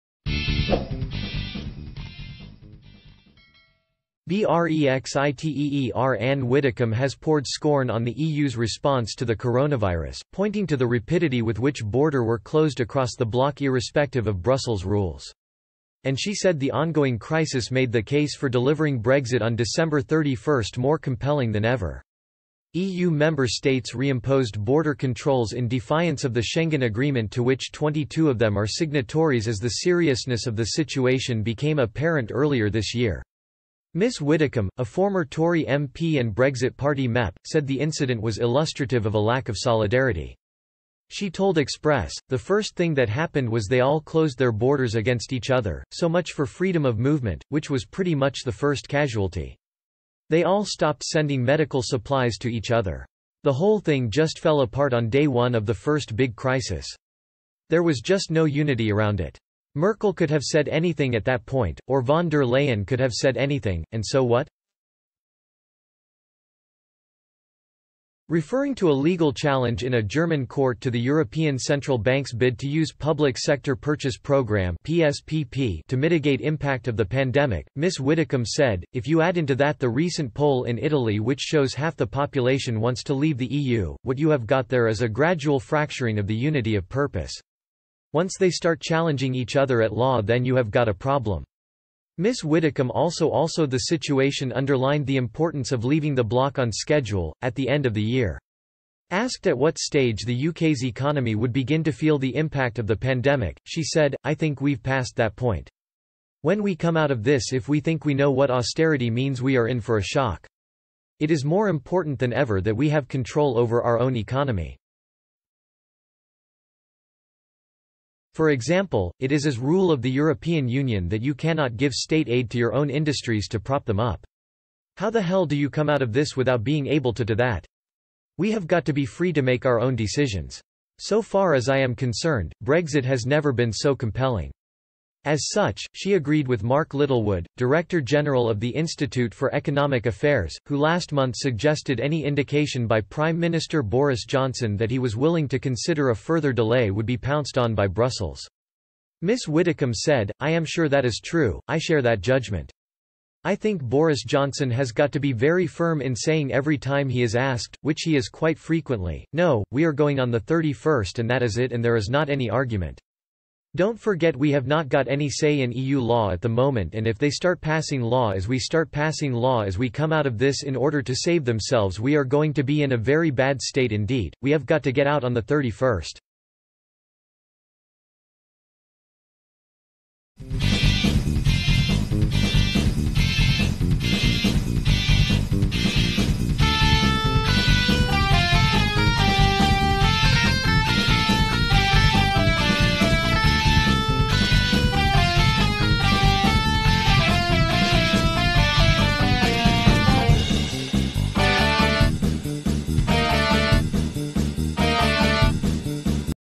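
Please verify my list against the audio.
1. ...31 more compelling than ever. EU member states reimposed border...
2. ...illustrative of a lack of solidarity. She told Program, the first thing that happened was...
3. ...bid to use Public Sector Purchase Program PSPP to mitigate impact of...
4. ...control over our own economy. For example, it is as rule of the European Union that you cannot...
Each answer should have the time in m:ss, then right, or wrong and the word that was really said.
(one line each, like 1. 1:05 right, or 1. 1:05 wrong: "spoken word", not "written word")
1. 0:20 right
2. 0:38 wrong: "Express", not "Program"
3. 1:12 right
4. 1:53 right.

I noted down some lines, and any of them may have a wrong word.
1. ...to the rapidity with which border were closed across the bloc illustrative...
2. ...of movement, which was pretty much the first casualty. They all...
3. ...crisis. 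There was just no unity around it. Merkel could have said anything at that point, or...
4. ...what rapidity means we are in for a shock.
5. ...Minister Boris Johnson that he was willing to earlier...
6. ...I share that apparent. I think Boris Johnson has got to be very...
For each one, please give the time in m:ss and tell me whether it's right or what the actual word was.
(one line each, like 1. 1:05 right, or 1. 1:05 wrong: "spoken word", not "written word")
1. 0:10 wrong: "irrespective", not "illustrative"
2. 0:46 right
3. 0:56 right
4. 1:48 wrong: "austerity", not "rapidity"
5. 2:23 wrong: "consider", not "earlier"
6. 2:31 wrong: "judgment", not "apparent".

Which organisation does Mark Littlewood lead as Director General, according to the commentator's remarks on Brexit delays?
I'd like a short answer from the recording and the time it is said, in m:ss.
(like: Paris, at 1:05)
Institute for Economic Affairs, at 2:18.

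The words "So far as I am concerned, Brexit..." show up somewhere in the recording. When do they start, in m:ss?
2:10.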